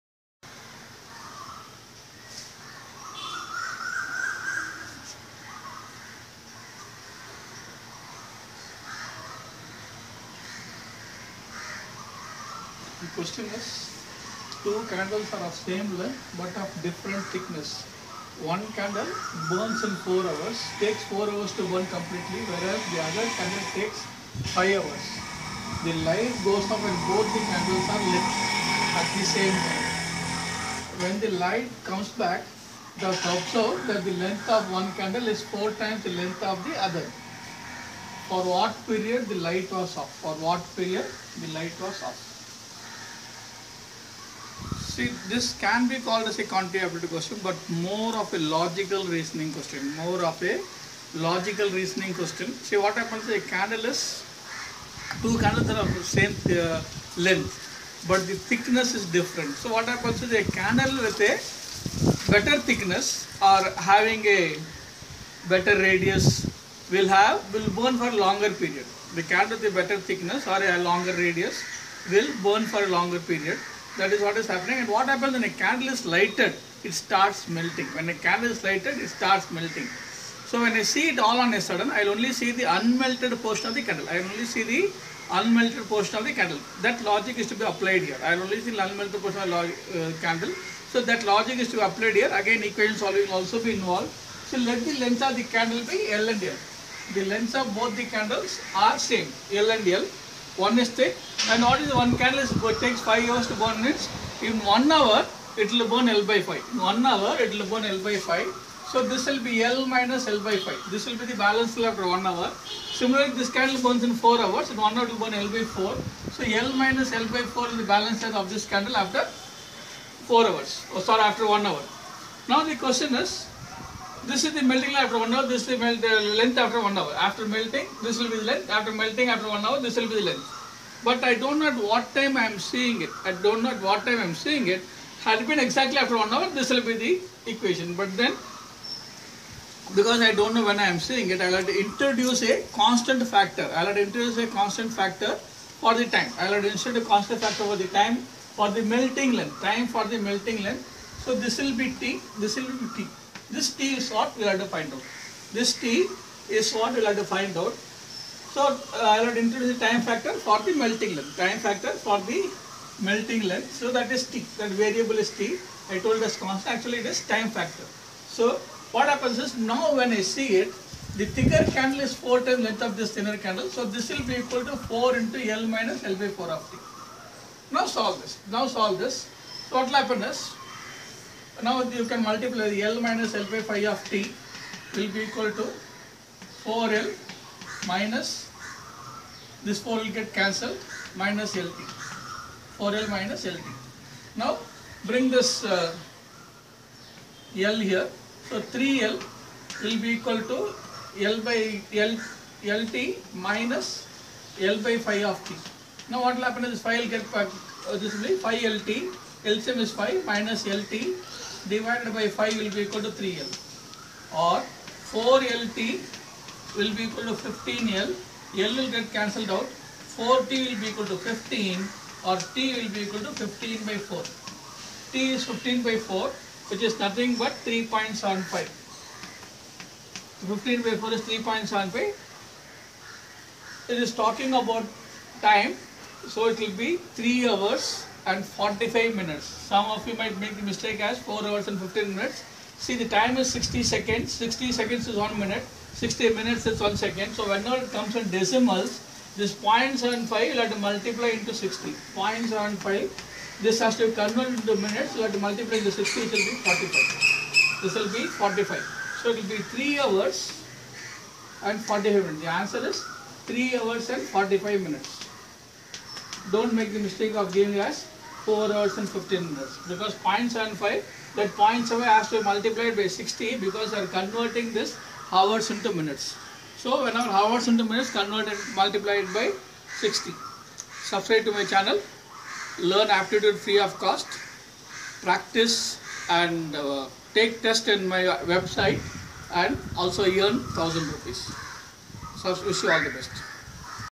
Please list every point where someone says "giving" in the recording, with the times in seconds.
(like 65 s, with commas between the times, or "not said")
267 s.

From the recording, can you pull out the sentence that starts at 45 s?
See, this can be called as a quantitative question, but more of a logical reasoning question.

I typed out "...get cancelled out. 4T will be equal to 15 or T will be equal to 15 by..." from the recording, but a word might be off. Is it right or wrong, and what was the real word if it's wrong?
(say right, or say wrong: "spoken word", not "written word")
right.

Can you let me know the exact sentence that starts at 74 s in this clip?
And what happens when a candle is lighted, it starts melting.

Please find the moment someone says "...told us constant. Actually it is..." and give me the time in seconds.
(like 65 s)
165 s.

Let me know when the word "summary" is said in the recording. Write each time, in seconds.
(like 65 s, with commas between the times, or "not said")
not said.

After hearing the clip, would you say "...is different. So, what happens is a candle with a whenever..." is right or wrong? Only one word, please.
wrong.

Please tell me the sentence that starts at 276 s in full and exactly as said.
So whenever hours into minutes converted multiplied by 60.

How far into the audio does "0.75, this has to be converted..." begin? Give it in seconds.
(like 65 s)
252 s.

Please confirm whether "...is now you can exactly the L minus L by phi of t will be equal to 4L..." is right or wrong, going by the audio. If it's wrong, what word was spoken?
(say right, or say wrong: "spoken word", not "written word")
wrong: "multiply", not "exactly".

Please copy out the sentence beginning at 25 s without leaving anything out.
The light goes off when both the candles are lit at the same time.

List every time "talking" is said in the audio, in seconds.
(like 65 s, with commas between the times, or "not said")
234 s.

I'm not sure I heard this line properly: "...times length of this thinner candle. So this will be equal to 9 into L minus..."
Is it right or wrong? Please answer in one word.
wrong.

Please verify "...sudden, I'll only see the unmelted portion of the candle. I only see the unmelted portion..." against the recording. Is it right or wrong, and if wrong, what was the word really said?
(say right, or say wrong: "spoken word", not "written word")
right.